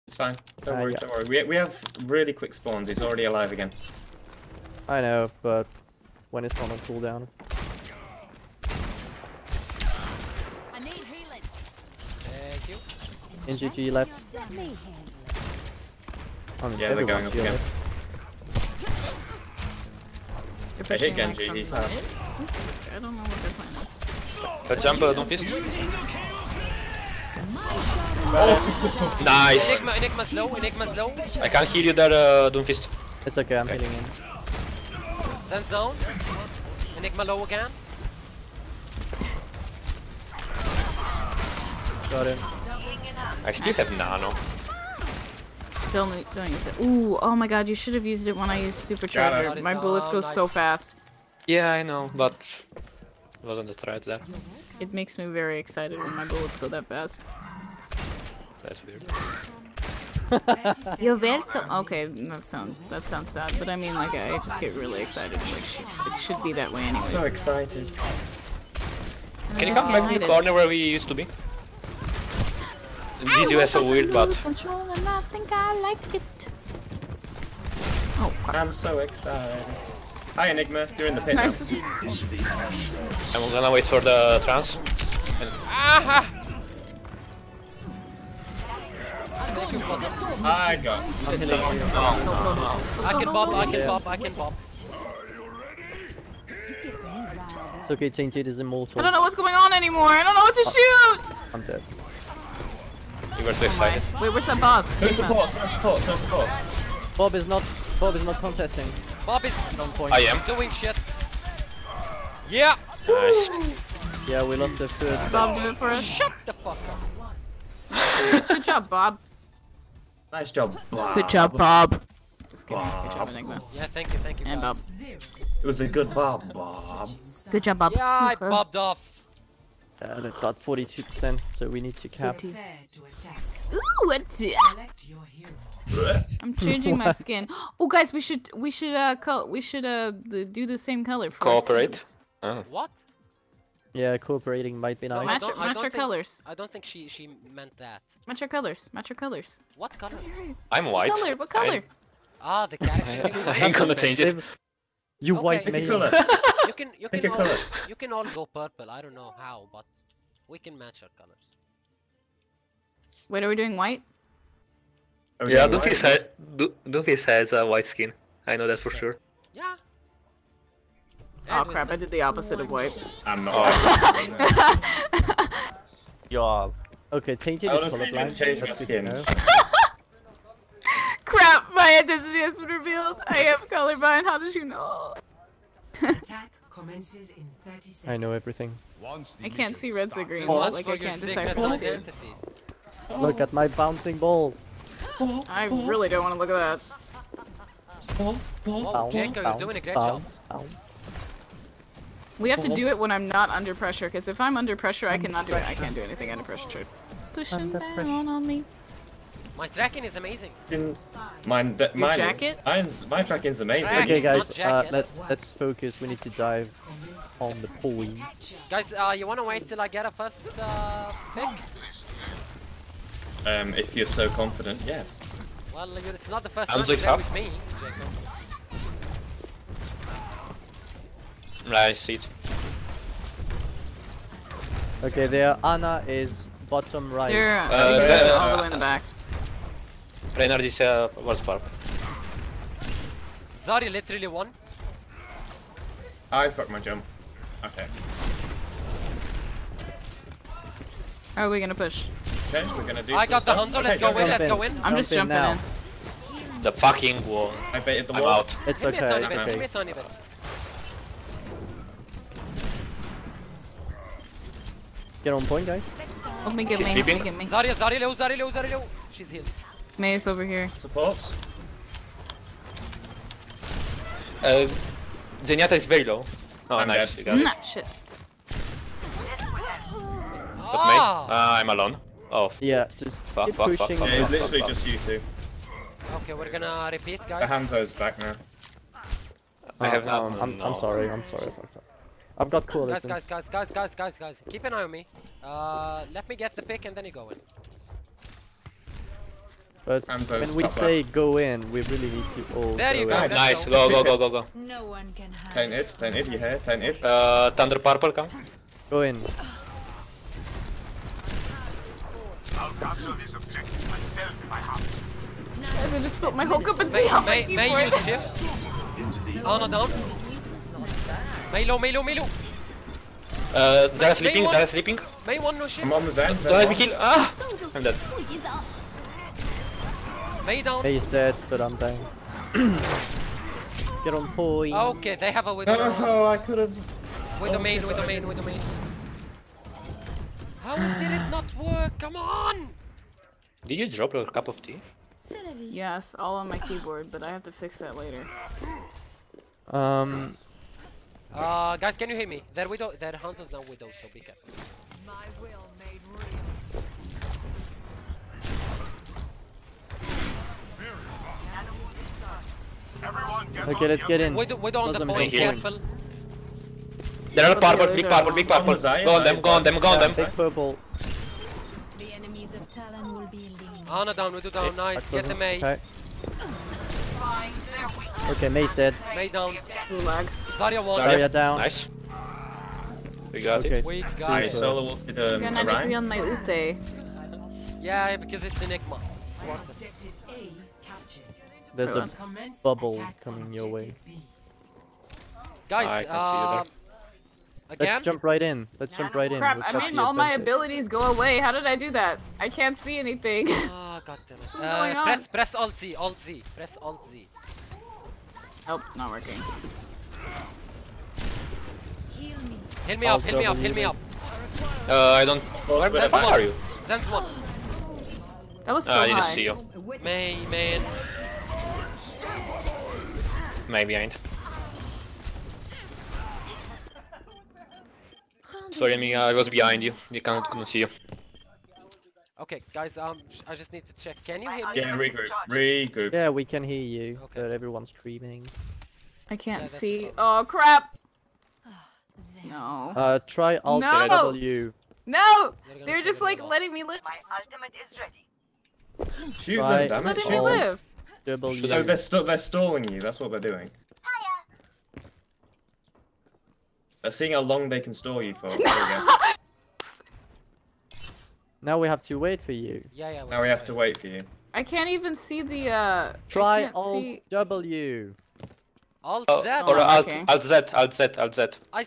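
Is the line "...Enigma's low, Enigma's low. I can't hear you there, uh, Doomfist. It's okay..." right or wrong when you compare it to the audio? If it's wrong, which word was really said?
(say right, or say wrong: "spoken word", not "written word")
right.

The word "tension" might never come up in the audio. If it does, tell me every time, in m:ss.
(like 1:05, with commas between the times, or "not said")
not said.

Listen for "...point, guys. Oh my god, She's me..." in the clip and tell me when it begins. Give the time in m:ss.
4:25.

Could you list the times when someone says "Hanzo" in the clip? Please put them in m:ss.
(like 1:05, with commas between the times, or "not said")
4:13, 4:47.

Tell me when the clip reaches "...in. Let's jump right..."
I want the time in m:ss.
6:38.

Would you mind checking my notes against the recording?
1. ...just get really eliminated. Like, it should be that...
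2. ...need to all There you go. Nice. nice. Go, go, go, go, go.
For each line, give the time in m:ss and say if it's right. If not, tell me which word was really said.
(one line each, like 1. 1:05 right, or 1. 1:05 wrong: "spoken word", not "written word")
1. 1:04 wrong: "excited", not "eliminated"
2. 5:02 right.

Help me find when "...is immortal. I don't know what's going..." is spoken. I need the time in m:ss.
1:38.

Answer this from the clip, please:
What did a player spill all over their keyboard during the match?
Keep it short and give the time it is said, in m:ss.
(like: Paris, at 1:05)
A cup of tea, at 5:44.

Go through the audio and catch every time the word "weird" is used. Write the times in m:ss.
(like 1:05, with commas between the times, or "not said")
0:58, 1:13.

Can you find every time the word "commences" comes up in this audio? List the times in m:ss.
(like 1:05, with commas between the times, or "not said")
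3:06.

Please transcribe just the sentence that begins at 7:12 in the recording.
Okay, guys, um, I just need to check.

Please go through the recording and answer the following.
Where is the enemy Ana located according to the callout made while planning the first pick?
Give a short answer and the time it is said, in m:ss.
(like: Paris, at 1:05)
Bottom right, at 3:56.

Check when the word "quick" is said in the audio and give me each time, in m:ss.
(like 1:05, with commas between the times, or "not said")
0:02.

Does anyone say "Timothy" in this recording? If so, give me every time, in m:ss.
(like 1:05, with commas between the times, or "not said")
not said.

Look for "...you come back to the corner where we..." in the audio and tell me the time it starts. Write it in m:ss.
1:09.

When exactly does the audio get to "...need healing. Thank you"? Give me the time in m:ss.
0:10.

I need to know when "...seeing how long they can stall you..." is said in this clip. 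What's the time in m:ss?
7:37.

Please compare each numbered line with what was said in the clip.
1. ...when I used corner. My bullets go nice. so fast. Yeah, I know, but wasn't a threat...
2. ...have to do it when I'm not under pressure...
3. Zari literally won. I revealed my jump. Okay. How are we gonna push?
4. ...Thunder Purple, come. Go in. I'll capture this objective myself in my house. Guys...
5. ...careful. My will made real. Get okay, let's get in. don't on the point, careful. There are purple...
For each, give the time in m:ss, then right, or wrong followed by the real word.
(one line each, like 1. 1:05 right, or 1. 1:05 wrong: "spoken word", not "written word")
1. 0:48 wrong: "supercharger", not "corner"
2. 3:22 right
3. 4:03 wrong: "fucked", not "revealed"
4. 5:07 right
5. 5:54 right.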